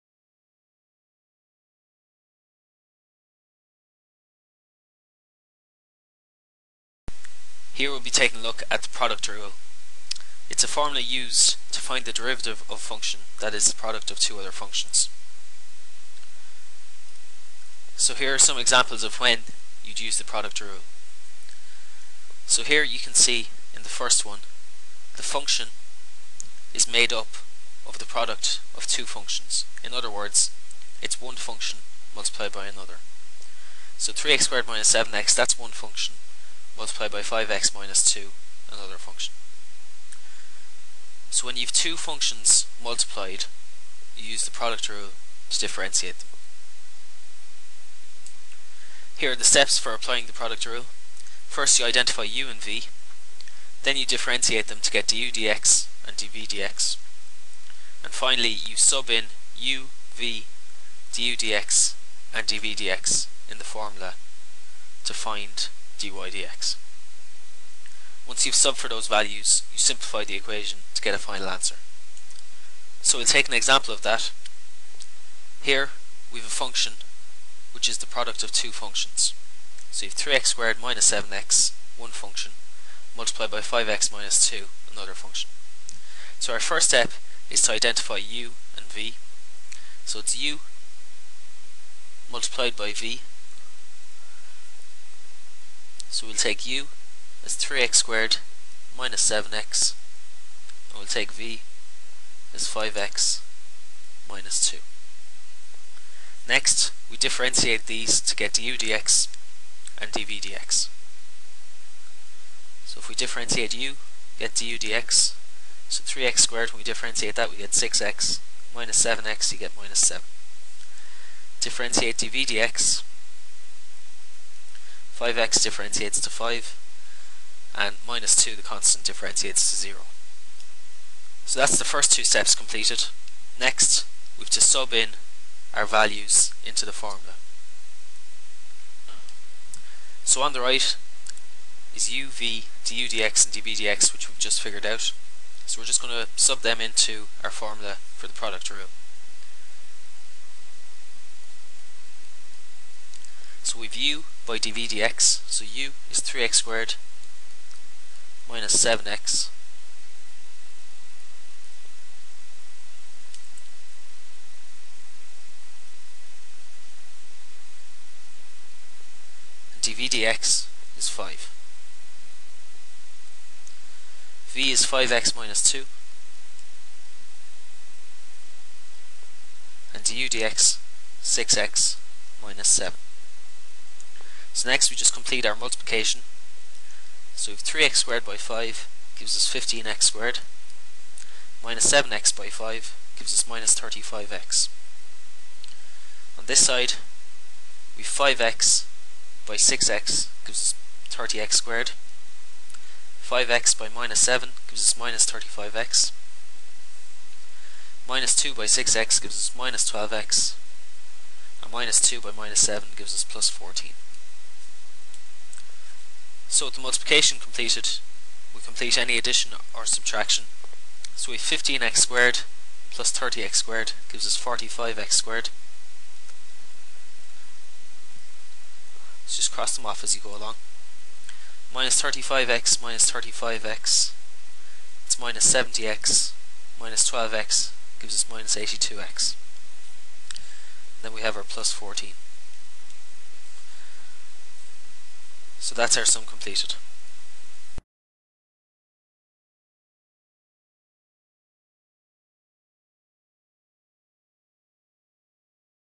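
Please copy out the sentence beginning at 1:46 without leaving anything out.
Next, we differentiate these to get du dx and dv dx.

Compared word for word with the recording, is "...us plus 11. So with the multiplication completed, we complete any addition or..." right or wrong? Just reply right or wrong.
wrong.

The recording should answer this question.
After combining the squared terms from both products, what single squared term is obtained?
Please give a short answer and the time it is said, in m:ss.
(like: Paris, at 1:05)
45x squared, at 3:44.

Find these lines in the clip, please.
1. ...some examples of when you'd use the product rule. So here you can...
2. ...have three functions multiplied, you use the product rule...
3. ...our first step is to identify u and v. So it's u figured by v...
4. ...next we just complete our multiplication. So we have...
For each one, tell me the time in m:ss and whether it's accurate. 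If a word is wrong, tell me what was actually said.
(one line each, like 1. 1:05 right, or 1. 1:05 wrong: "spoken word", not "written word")
1. 0:18 right
2. 0:41 wrong: "two", not "three"
3. 1:26 wrong: "multiplied", not "figured"
4. 3:04 right.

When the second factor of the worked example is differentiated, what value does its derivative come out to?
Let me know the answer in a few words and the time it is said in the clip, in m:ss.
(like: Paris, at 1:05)
5, at 2:05.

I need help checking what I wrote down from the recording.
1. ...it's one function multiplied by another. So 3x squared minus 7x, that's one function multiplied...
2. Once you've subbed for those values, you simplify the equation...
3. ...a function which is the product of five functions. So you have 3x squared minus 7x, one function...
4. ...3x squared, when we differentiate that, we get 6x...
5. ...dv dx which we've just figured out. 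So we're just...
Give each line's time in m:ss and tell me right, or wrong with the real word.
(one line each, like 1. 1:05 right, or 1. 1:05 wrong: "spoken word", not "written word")
1. 0:31 right
2. 1:08 right
3. 1:16 wrong: "two", not "five"
4. 1:56 right
5. 2:23 right.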